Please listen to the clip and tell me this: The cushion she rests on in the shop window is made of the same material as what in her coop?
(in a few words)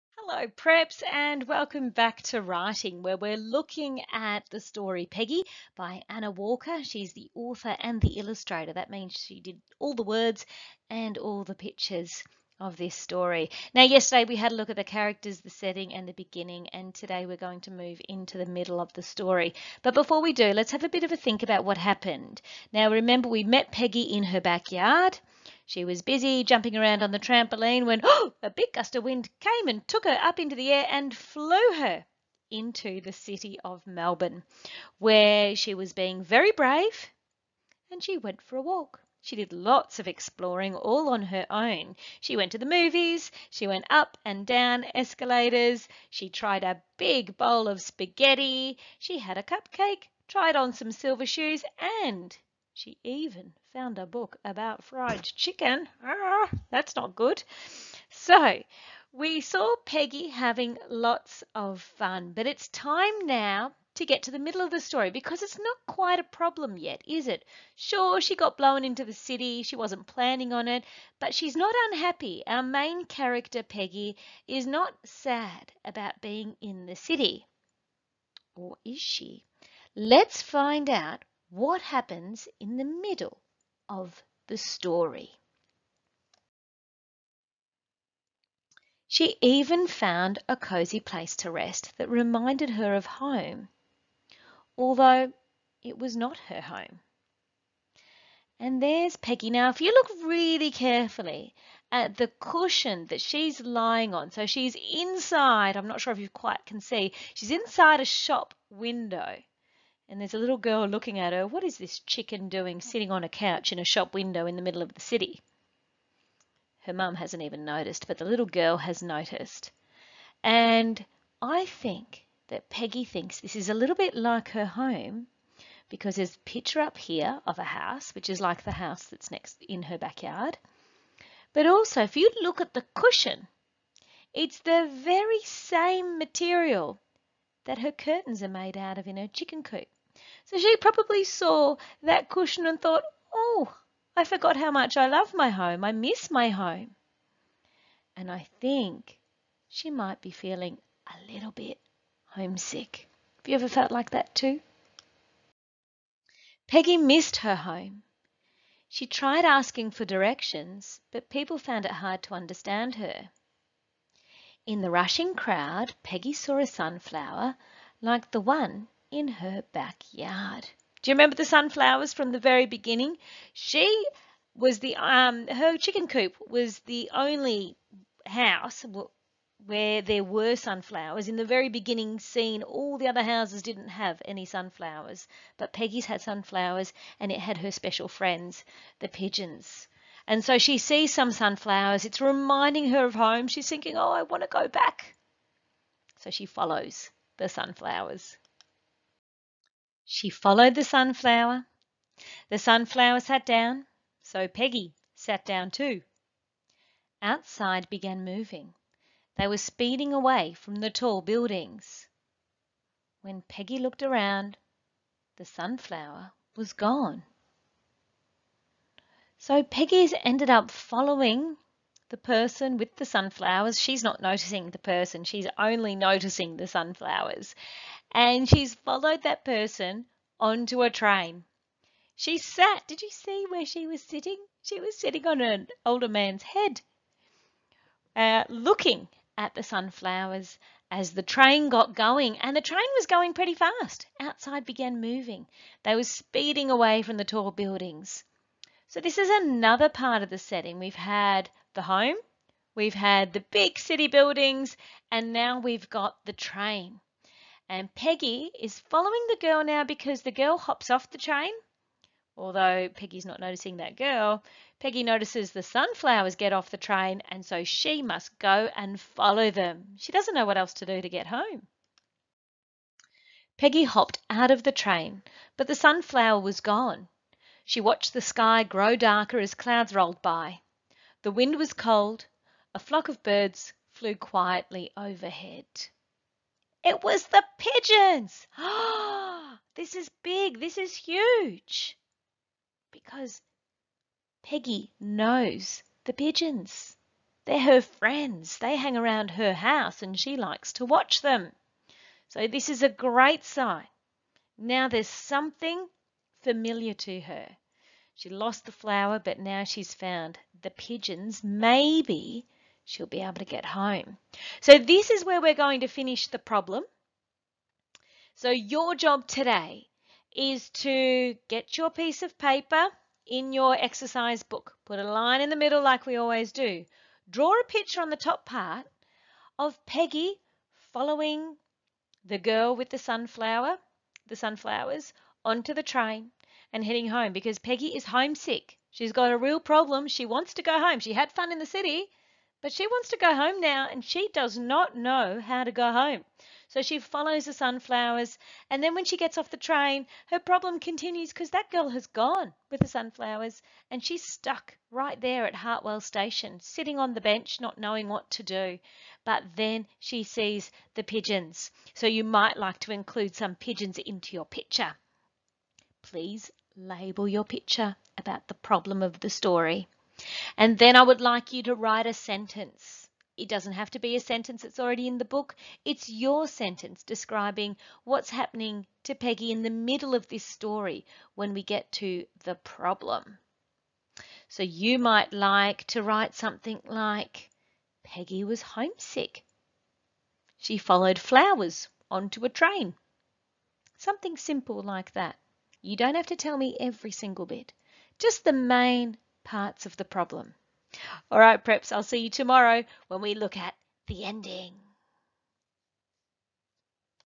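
Her curtains.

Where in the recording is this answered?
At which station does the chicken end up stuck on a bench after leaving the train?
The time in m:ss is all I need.
5:55.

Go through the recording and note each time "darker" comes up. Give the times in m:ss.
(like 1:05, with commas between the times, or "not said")
4:38.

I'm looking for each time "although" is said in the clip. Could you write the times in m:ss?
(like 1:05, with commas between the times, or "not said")
1:34, 4:22.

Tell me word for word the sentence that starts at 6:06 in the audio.
Please label your picture about the problem of the story.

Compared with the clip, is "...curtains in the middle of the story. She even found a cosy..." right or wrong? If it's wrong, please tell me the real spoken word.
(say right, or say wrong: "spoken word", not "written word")
wrong: "happens", not "curtains".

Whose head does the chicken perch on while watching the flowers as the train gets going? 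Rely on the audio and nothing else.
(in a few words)
An older man's.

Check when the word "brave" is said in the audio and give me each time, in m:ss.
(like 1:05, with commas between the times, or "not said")
0:36.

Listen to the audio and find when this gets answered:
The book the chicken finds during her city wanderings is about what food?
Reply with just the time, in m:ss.
0:54.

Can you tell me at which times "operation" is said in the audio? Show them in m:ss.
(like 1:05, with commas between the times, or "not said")
not said.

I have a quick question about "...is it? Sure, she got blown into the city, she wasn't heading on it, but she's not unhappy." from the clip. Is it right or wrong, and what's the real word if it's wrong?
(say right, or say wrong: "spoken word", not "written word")
wrong: "planning", not "heading".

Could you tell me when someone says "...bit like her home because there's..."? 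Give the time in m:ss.
2:03.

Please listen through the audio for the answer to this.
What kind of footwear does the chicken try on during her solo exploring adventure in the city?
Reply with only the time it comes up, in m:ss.
0:50.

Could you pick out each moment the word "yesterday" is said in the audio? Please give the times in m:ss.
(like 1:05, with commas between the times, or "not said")
0:13.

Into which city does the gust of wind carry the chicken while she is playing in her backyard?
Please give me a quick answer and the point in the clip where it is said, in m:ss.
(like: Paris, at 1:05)
Melbourne, at 0:33.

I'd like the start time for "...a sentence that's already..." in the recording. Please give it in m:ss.
6:14.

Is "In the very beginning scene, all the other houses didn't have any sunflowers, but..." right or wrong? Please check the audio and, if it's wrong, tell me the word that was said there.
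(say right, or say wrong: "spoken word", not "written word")
right.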